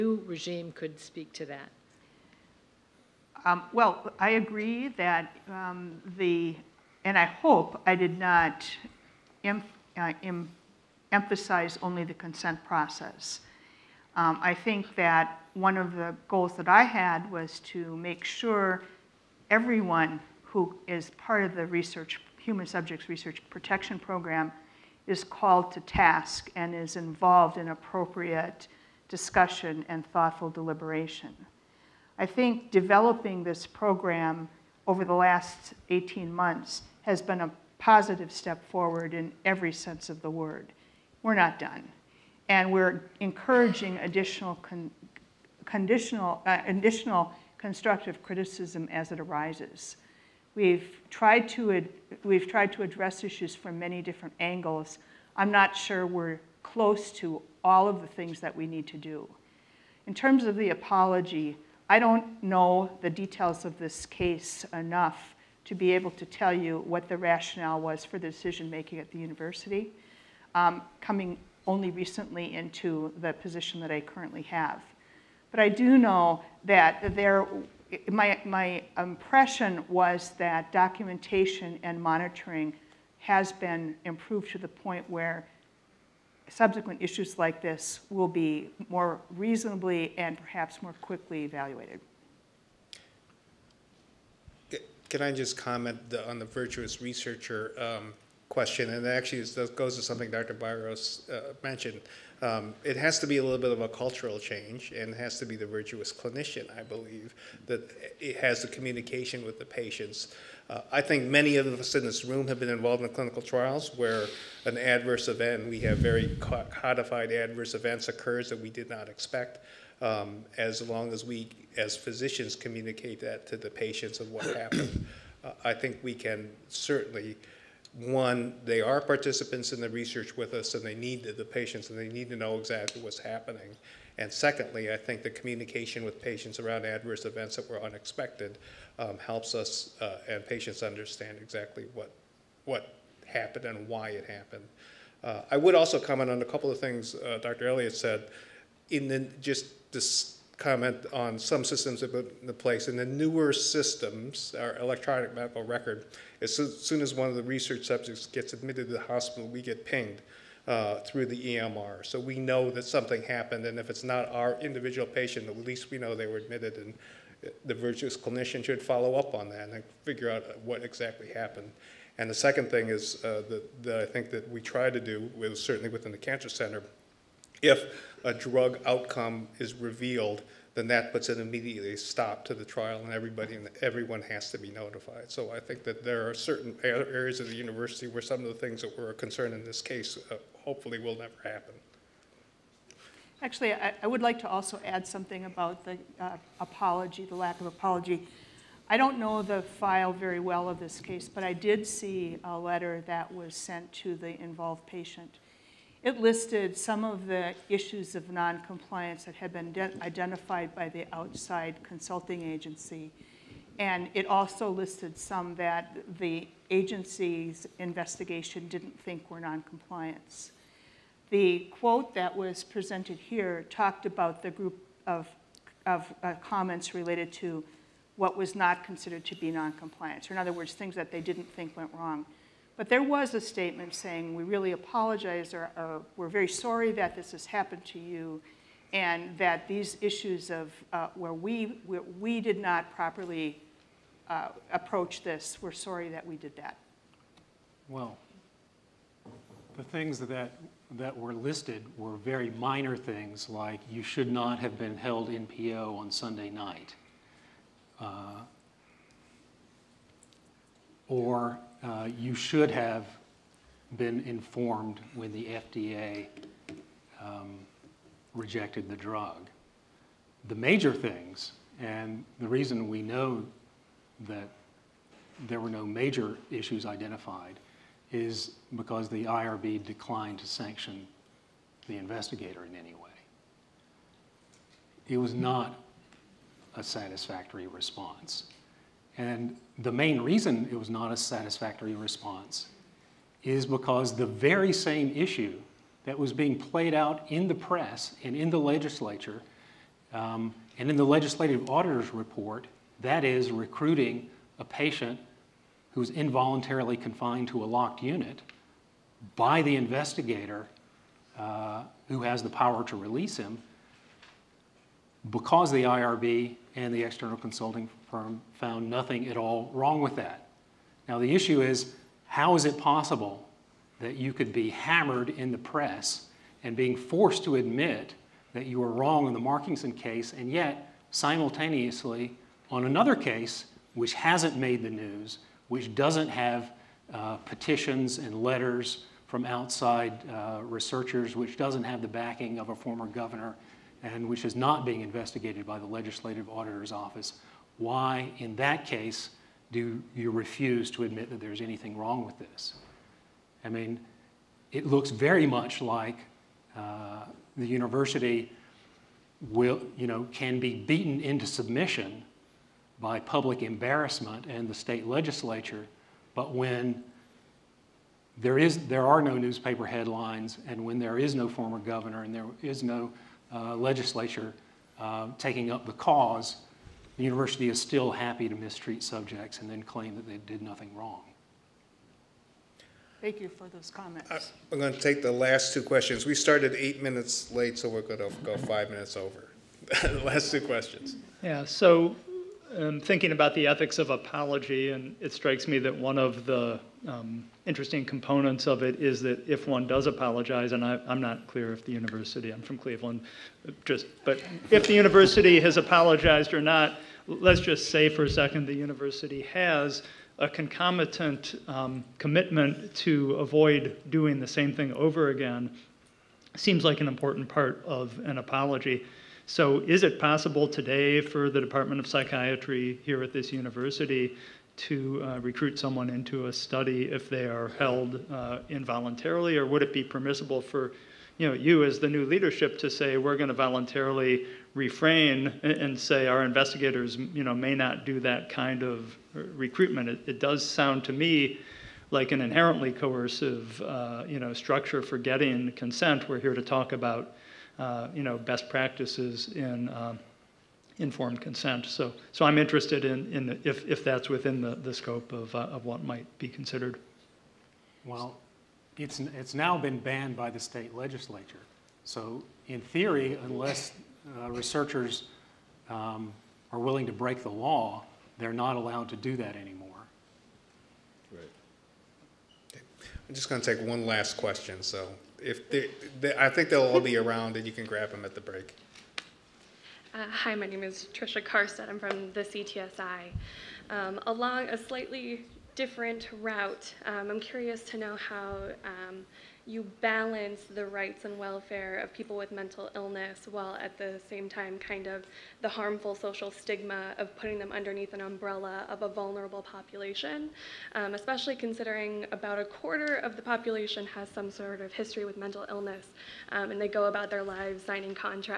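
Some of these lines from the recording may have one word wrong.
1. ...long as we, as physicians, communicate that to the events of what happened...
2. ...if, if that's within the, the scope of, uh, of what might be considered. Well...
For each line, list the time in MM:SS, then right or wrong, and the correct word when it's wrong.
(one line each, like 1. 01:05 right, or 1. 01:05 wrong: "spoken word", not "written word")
1. 02:00 wrong: "patients", not "events"
2. 07:33 right.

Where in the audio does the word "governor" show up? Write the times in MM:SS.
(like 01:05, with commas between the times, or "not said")
05:43, 06:11.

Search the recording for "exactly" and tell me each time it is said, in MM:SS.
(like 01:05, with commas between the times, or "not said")
02:12, 02:21, 02:50.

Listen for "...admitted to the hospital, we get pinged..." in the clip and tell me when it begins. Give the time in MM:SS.
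02:38.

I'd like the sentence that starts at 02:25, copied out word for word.
Uh, I would also comment on a couple of things uh, Dr.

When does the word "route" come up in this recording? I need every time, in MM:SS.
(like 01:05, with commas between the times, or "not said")
08:06.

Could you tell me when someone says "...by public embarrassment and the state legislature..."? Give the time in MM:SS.
06:03.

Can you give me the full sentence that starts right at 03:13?
Actually, I, I, would like to also add something about the uh, apology, the lack of apology.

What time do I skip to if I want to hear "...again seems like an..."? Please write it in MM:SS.
06:55.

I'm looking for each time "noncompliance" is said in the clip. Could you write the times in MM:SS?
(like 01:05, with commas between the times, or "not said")
03:28, 03:39, 03:49.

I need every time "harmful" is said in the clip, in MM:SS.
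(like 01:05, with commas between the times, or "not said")
08:15.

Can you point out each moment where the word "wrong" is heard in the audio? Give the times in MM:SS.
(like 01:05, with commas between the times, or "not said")
03:51, 05:19, 05:28, 05:51, 06:20.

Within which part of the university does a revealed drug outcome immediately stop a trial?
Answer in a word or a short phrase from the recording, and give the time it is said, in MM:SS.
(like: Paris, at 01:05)
Cancer Center, at 02:56.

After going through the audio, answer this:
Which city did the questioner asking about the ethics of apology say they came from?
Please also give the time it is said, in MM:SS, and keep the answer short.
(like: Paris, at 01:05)
Cleveland, at 06:42.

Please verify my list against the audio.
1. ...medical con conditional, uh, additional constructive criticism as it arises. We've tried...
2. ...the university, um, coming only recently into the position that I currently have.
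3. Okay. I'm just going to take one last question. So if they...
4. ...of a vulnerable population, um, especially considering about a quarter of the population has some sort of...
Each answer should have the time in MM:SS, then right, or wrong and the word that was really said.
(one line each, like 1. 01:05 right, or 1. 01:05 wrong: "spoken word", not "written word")
1. 00:43 wrong: "additional", not "medical"
2. 01:09 right
3. 07:52 right
4. 08:18 right.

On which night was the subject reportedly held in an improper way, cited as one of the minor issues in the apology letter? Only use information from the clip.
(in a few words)
Sunday.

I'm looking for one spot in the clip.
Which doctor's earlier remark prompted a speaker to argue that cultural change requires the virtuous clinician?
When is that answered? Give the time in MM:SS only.
01:40.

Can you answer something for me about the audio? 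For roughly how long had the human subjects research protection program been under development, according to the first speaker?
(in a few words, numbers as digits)
18 months.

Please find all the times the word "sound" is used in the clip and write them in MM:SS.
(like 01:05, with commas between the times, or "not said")
07:20.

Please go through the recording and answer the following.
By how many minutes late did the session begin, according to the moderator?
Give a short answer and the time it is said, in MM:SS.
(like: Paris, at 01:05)
8, at 06:26.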